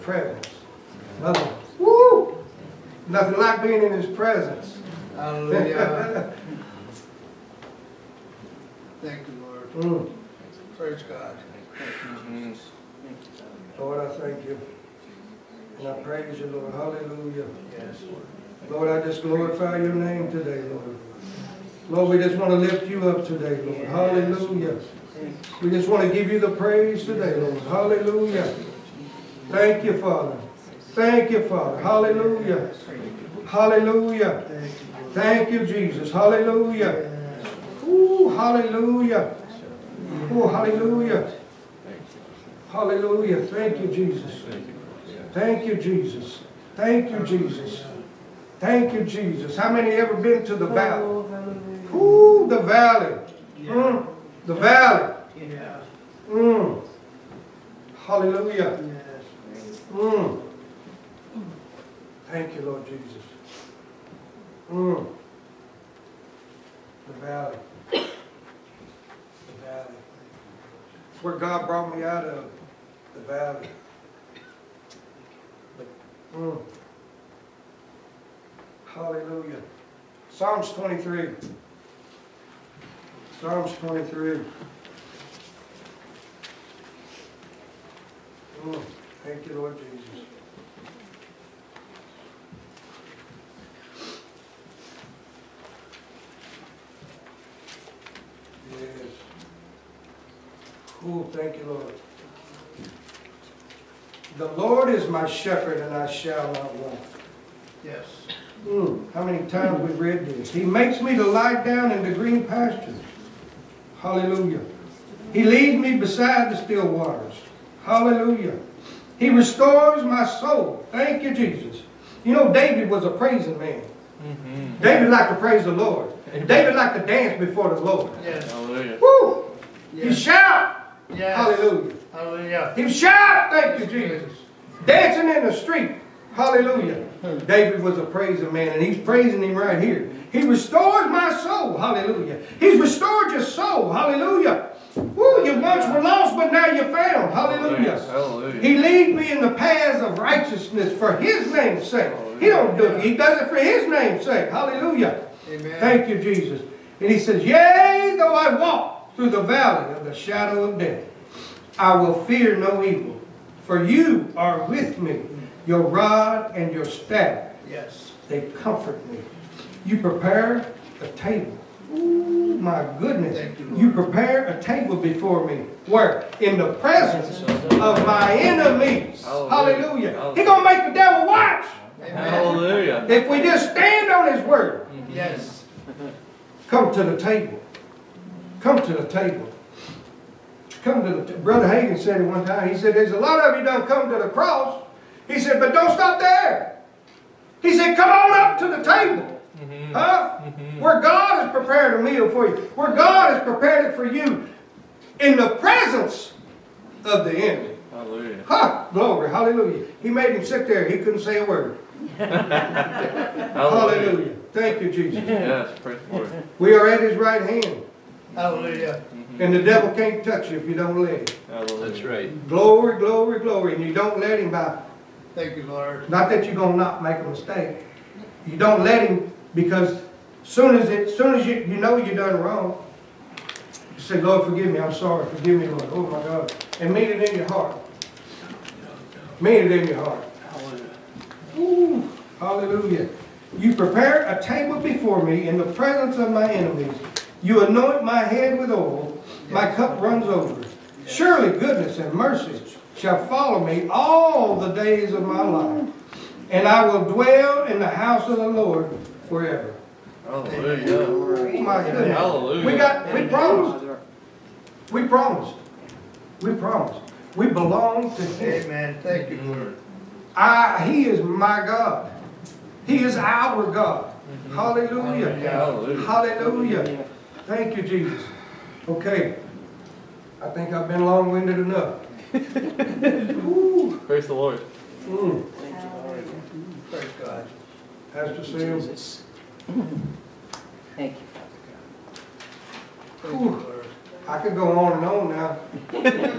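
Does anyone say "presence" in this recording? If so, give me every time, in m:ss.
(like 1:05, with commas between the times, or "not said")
0:00, 0:04, 2:56, 3:25, 4:05.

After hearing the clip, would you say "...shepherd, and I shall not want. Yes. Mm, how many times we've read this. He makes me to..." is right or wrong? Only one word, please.
right.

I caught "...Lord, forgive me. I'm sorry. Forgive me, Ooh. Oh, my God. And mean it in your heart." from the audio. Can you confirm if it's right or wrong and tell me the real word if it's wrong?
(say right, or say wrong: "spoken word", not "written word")
wrong: "Lord", not "Ooh".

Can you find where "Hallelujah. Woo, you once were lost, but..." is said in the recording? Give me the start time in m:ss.
2:23.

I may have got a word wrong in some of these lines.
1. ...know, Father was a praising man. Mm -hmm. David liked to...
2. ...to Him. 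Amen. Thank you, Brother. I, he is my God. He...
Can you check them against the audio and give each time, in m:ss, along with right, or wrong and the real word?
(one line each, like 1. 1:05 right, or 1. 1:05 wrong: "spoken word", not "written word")
1. 2:02 wrong: "David", not "Father"
2. 4:28 wrong: "Lord", not "Brother".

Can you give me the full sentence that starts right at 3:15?
He said, but don't stop there.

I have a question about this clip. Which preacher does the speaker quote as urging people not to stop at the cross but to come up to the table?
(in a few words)
Brother Hagin.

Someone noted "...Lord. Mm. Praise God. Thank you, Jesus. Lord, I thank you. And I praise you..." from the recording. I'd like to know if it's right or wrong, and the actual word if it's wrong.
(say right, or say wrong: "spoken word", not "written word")
right.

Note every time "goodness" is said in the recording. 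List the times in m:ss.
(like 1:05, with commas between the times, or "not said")
2:52, 4:11, 4:21.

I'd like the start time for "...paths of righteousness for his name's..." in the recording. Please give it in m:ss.
2:29.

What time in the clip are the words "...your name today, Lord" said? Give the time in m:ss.
0:19.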